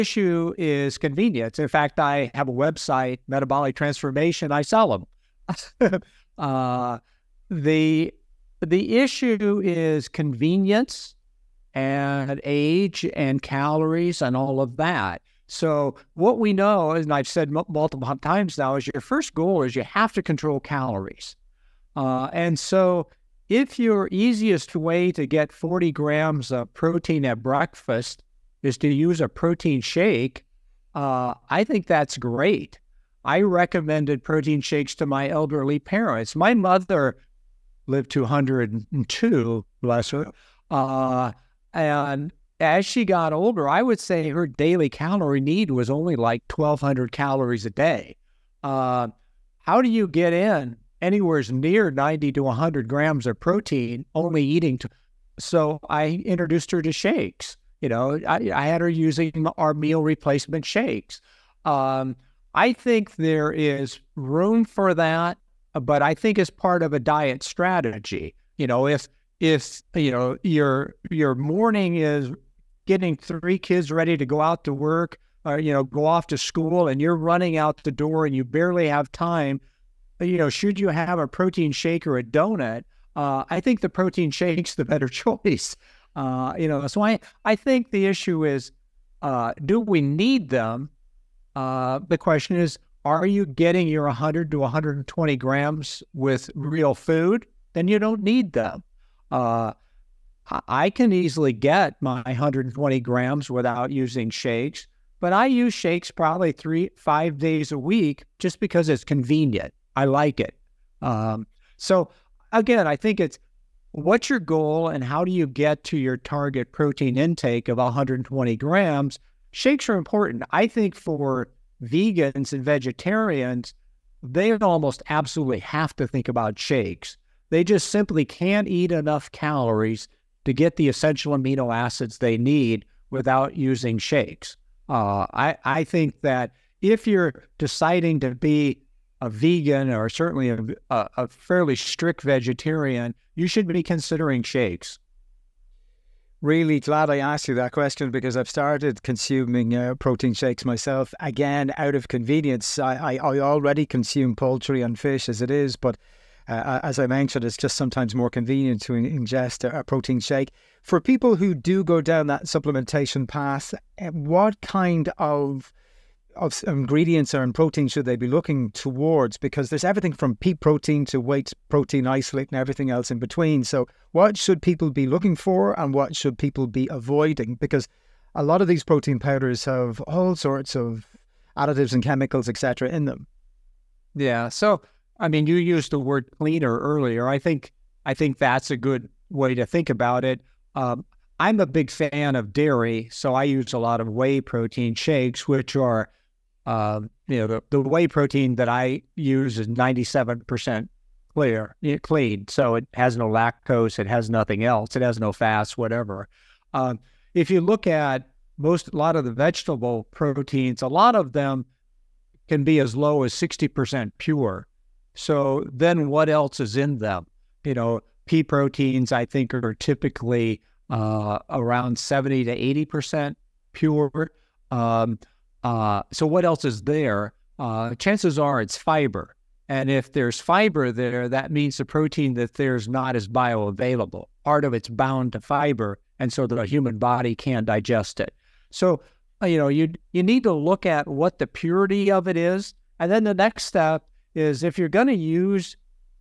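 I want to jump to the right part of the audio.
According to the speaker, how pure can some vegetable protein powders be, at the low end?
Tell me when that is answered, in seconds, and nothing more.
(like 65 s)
213 s.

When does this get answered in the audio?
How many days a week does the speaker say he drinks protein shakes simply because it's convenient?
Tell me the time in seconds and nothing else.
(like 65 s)
106 s.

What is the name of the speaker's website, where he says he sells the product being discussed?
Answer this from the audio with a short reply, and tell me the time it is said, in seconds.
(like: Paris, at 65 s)
Metabolic Transformation, at 3 s.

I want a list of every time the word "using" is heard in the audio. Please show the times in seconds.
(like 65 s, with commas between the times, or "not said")
58 s, 103 s, 133 s.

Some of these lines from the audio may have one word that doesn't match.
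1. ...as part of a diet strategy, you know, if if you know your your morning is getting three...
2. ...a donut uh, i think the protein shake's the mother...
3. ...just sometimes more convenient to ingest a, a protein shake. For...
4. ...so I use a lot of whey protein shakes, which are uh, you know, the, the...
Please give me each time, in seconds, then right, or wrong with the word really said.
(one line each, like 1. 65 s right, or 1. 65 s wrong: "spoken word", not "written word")
1. 66 s right
2. 82 s wrong: "better", not "mother"
3. 157 s right
4. 193 s right.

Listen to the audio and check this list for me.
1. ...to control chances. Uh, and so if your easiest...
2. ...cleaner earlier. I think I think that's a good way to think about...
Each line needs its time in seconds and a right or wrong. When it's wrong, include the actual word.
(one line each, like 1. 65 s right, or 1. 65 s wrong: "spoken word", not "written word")
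1. 20 s wrong: "calories", not "chances"
2. 186 s right.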